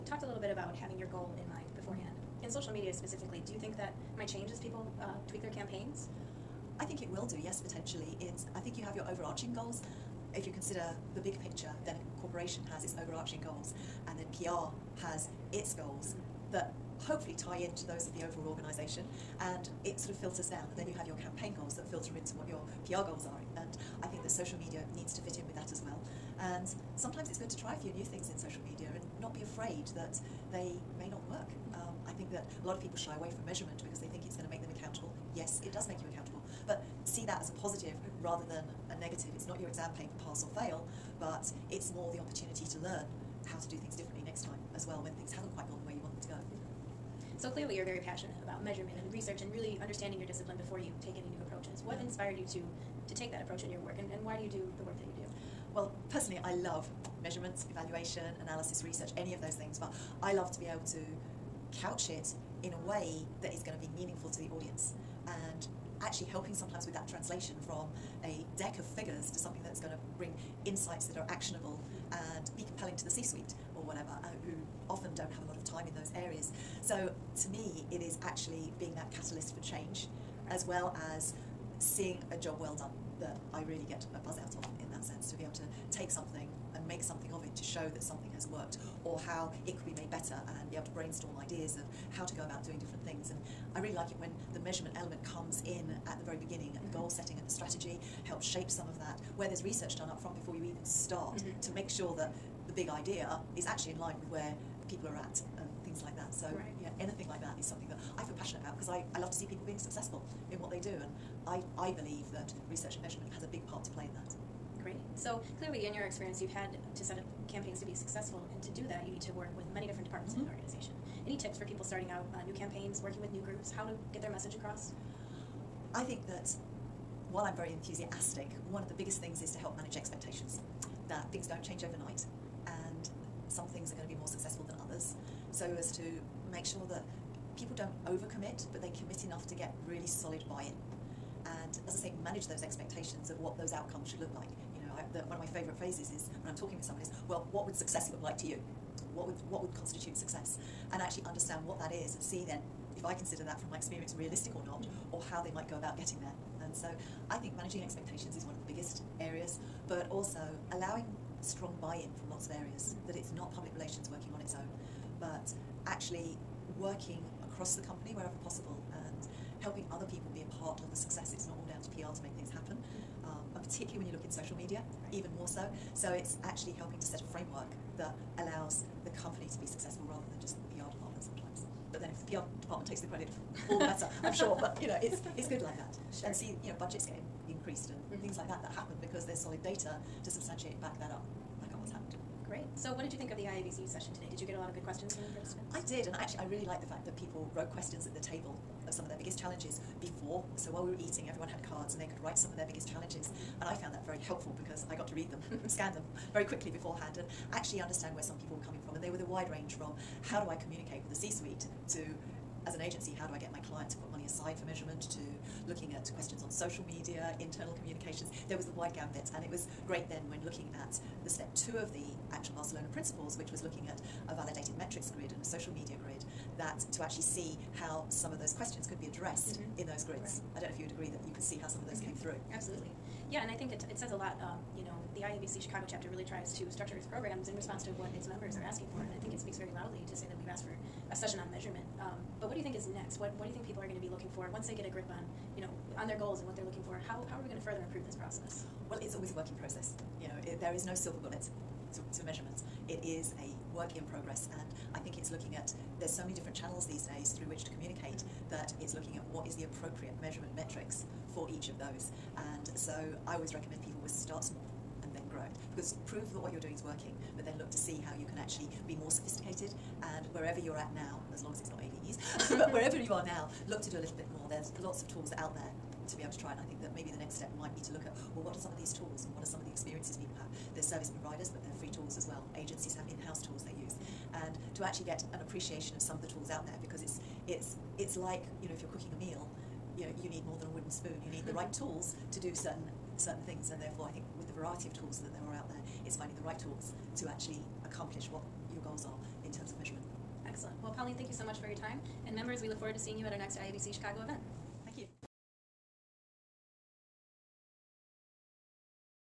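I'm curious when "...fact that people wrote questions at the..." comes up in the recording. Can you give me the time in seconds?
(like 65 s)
196 s.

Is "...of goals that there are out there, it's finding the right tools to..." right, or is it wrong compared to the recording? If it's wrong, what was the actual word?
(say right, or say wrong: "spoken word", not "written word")
wrong: "tools", not "goals".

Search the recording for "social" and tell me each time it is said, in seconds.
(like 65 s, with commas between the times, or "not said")
2 s, 24 s, 28 s, 174 s, 216 s, 225 s.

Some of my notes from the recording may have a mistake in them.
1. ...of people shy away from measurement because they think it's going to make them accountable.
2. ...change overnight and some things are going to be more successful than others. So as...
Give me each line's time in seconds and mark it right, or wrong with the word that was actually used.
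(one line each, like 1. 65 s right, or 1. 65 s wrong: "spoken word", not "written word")
1. 32 s right
2. 131 s right.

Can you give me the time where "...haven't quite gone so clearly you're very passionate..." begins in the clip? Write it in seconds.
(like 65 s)
45 s.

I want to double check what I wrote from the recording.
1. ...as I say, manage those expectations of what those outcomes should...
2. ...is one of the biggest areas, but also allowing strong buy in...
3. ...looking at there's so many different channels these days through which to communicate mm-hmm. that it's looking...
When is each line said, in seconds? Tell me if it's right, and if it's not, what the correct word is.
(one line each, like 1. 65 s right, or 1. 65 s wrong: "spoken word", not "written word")
1. 141 s right
2. 158 s right
3. 255 s right.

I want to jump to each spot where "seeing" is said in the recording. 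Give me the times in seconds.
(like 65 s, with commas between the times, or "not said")
81 s, 302 s.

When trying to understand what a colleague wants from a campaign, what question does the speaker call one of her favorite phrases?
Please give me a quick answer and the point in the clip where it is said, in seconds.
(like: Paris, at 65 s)
What would success look like to you?, at 147 s.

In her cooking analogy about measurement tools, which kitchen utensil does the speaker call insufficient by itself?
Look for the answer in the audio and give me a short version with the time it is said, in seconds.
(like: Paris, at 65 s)
wooden spoon, at 290 s.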